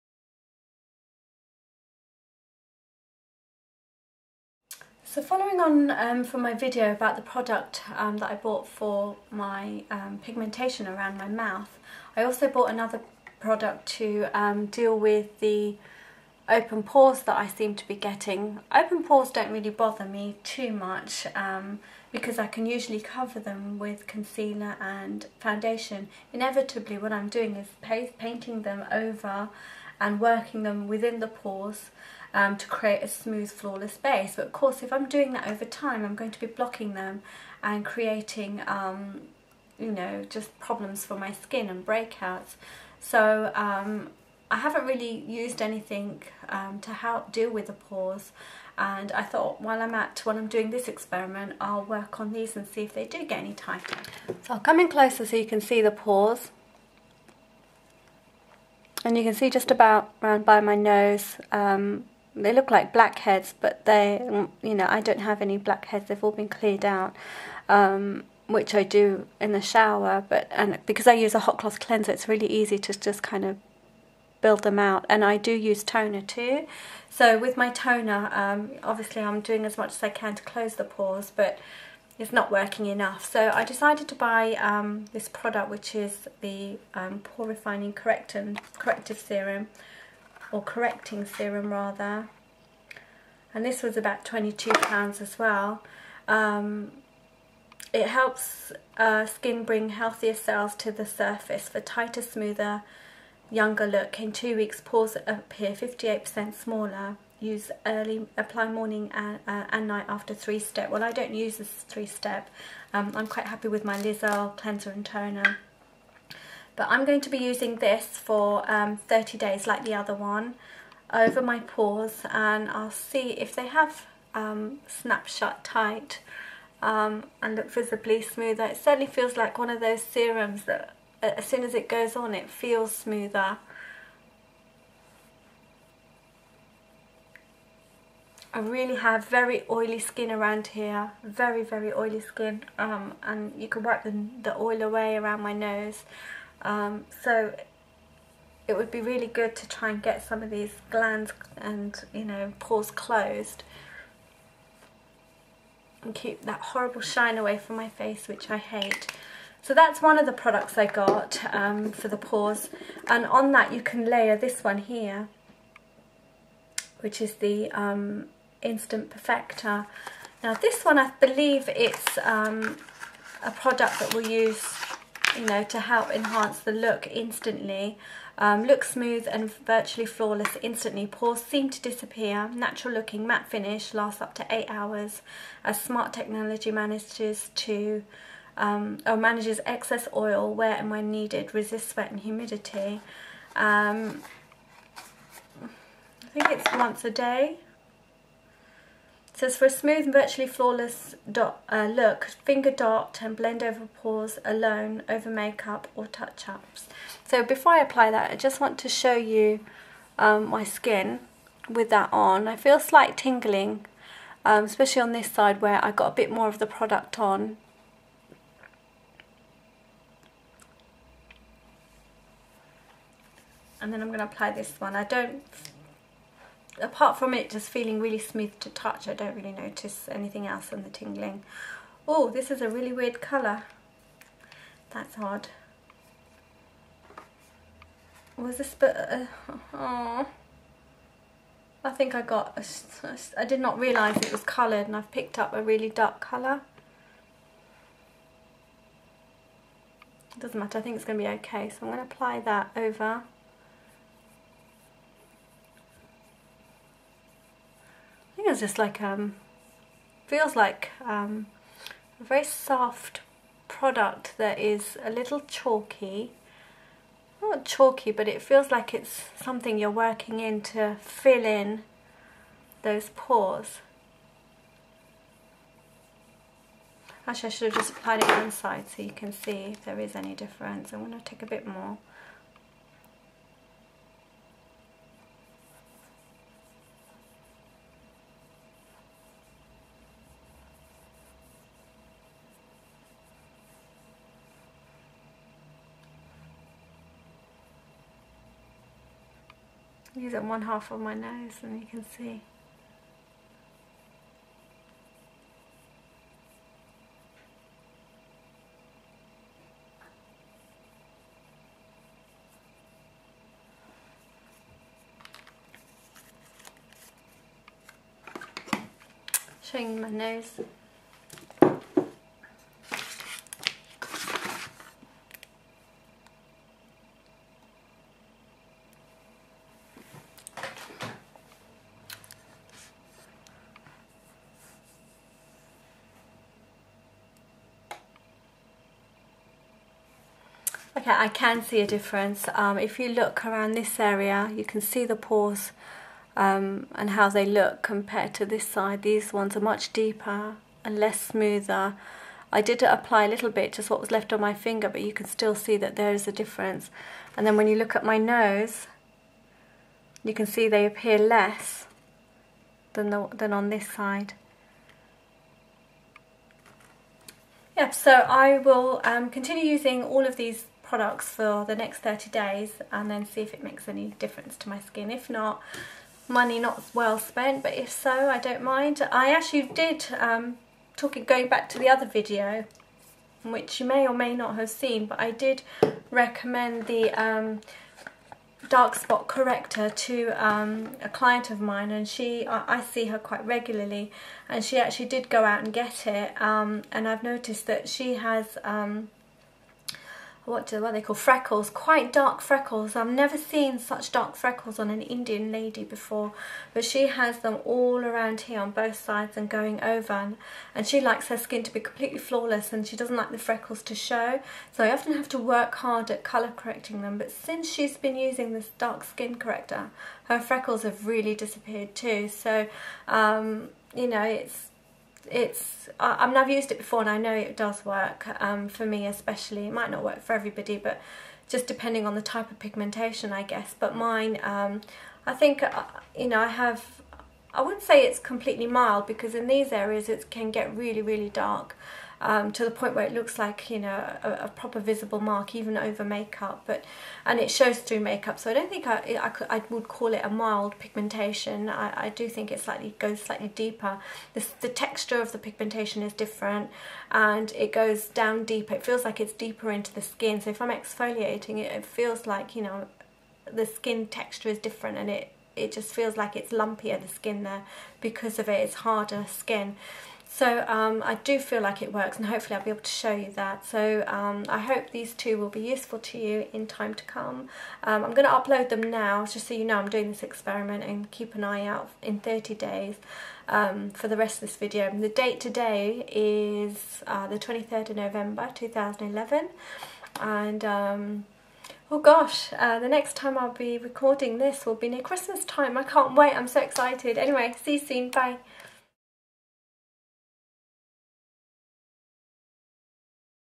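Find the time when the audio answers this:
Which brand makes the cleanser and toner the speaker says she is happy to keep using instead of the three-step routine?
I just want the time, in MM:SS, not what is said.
01:53.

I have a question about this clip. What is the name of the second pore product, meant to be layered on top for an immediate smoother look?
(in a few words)
Instant Perfector.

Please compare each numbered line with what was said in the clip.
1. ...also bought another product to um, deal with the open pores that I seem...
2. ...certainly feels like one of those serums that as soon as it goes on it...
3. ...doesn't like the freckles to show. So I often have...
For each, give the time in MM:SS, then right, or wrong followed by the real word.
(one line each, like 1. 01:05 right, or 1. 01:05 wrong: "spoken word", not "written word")
1. 00:12 right
2. 02:08 right
3. 06:52 right.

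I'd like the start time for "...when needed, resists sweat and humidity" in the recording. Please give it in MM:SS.
03:10.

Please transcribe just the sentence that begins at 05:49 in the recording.
These ones are much deeper and less smoother.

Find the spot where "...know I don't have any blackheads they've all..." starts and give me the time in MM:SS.
01:04.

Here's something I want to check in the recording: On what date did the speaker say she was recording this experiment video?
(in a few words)
23 November 2011.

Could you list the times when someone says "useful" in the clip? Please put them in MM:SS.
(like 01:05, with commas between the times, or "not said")
07:55.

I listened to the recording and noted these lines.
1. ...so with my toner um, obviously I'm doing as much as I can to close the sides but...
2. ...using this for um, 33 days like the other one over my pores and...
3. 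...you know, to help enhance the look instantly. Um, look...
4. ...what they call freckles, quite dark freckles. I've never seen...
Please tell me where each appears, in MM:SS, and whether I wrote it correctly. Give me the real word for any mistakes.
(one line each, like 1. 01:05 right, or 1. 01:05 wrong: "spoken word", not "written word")
1. 01:17 wrong: "pores", not "sides"
2. 01:57 wrong: "30", not "33"
3. 02:55 right
4. 06:40 right.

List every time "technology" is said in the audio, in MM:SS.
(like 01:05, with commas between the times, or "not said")
03:06.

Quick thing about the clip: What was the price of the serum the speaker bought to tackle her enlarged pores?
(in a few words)
£22.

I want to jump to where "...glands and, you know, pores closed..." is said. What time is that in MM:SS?
02:30.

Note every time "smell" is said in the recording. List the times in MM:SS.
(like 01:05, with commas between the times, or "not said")
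not said.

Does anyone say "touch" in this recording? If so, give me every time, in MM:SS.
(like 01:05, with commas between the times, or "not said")
03:26, 03:48.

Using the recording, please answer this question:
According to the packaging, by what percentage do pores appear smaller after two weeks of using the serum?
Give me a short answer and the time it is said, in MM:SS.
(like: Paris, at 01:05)
58%, at 01:45.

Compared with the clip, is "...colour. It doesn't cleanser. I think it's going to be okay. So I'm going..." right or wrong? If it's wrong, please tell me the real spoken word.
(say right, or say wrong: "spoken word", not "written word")
wrong: "matter", not "cleanser".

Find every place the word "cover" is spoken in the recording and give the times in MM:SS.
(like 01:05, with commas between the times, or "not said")
00:23.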